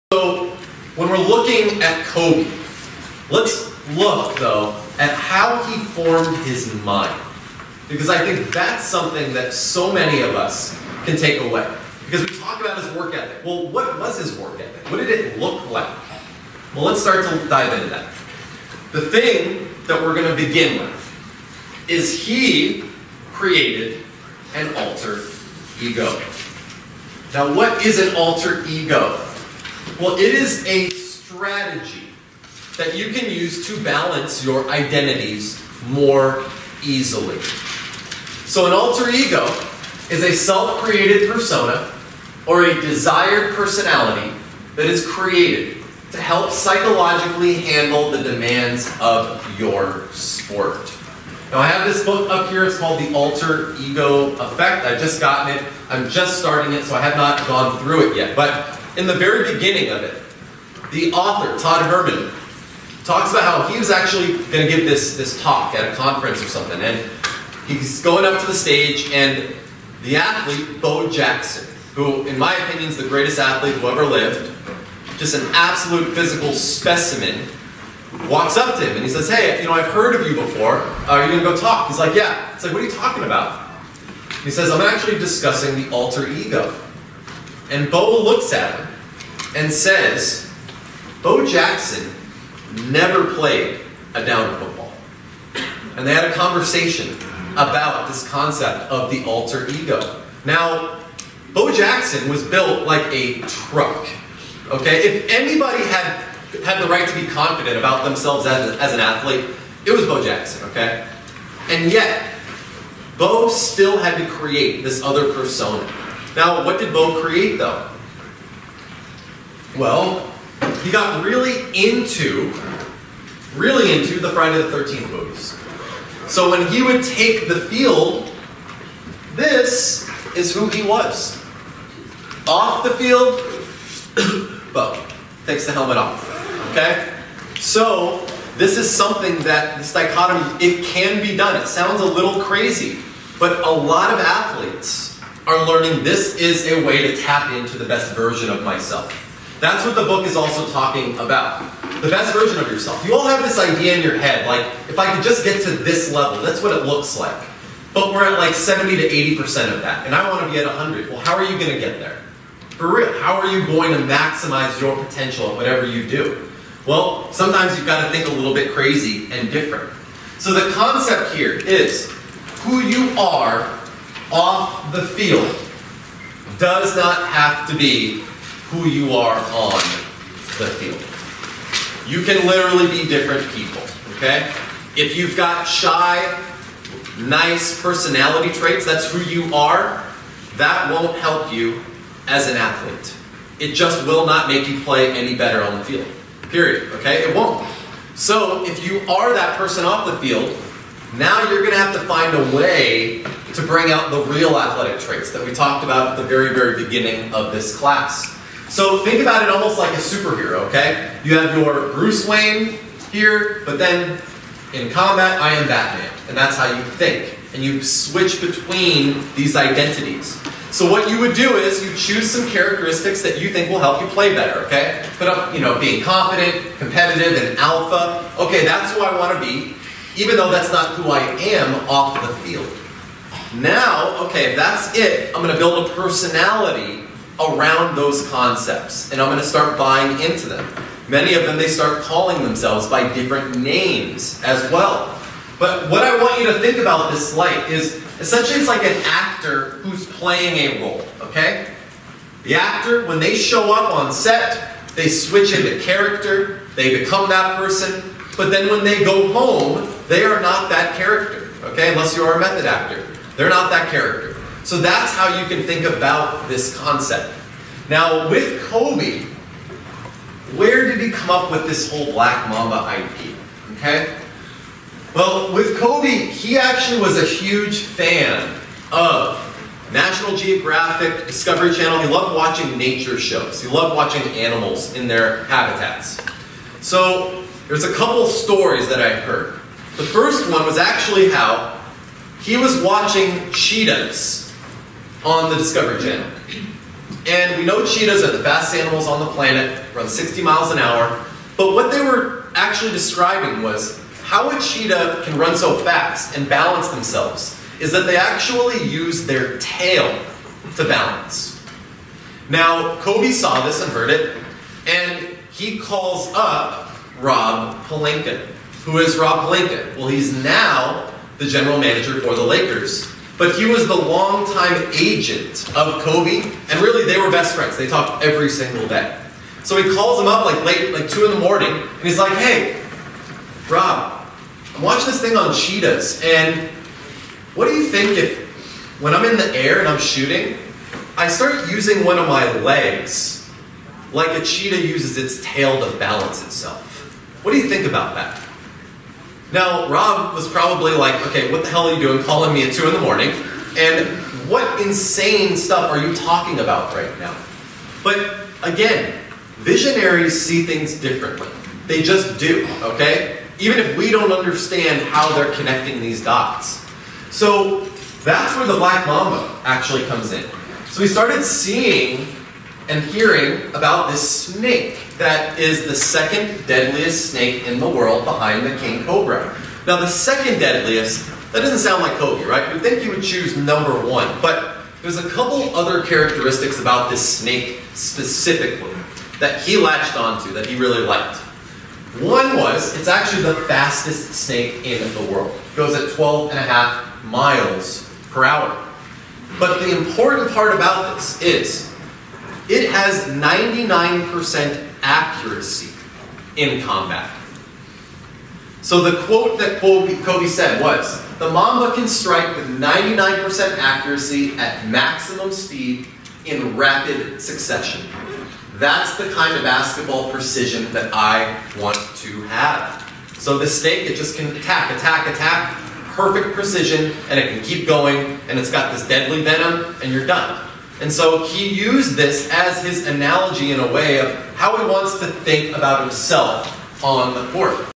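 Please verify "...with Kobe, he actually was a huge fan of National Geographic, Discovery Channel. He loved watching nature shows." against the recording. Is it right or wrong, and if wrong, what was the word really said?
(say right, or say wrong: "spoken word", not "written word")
right.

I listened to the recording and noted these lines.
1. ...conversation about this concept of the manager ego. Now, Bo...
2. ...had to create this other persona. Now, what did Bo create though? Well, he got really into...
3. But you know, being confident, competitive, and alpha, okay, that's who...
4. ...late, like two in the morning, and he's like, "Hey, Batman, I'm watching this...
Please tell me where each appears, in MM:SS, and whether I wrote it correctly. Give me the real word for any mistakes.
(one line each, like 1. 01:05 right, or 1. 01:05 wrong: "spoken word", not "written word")
1. 01:36 wrong: "alter", not "manager"
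2. 01:53 right
3. 03:45 right
4. 05:30 wrong: "Rob", not "Batman".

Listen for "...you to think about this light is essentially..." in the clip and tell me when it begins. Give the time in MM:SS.
04:06.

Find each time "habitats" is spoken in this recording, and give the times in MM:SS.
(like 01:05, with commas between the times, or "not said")
04:45.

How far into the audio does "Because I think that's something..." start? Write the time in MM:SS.
00:07.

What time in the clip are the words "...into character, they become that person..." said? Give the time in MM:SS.
04:15.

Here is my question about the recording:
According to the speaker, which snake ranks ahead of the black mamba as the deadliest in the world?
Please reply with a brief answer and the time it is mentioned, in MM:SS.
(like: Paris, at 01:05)
king cobra, at 06:18.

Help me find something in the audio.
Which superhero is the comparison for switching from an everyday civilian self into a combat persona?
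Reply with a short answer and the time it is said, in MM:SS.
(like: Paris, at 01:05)
Batman, at 03:35.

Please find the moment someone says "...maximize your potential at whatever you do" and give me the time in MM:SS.
02:44.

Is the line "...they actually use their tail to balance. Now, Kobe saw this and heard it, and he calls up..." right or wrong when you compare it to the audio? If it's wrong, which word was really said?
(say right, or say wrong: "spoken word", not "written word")
right.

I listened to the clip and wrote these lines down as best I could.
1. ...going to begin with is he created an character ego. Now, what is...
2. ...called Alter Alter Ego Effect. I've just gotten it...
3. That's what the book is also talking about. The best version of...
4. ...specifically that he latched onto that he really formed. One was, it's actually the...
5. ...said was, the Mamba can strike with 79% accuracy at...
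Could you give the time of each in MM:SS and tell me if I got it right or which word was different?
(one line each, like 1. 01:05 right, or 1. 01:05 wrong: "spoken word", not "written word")
1. 00:20 wrong: "alter", not "character"
2. 00:52 wrong: "The", not "Alter"
3. 02:29 right
4. 06:27 wrong: "liked", not "formed"
5. 06:50 wrong: "99", not "79".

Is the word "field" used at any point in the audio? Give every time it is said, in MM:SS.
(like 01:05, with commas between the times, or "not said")
02:07, 02:12, 02:55, 03:00, 03:15, 03:20, 03:52.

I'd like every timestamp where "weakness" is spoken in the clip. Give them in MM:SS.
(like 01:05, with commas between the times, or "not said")
not said.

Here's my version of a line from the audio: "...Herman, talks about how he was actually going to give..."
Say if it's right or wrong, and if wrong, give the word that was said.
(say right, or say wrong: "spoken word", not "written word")
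right.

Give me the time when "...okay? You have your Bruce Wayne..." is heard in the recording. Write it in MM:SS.
03:30.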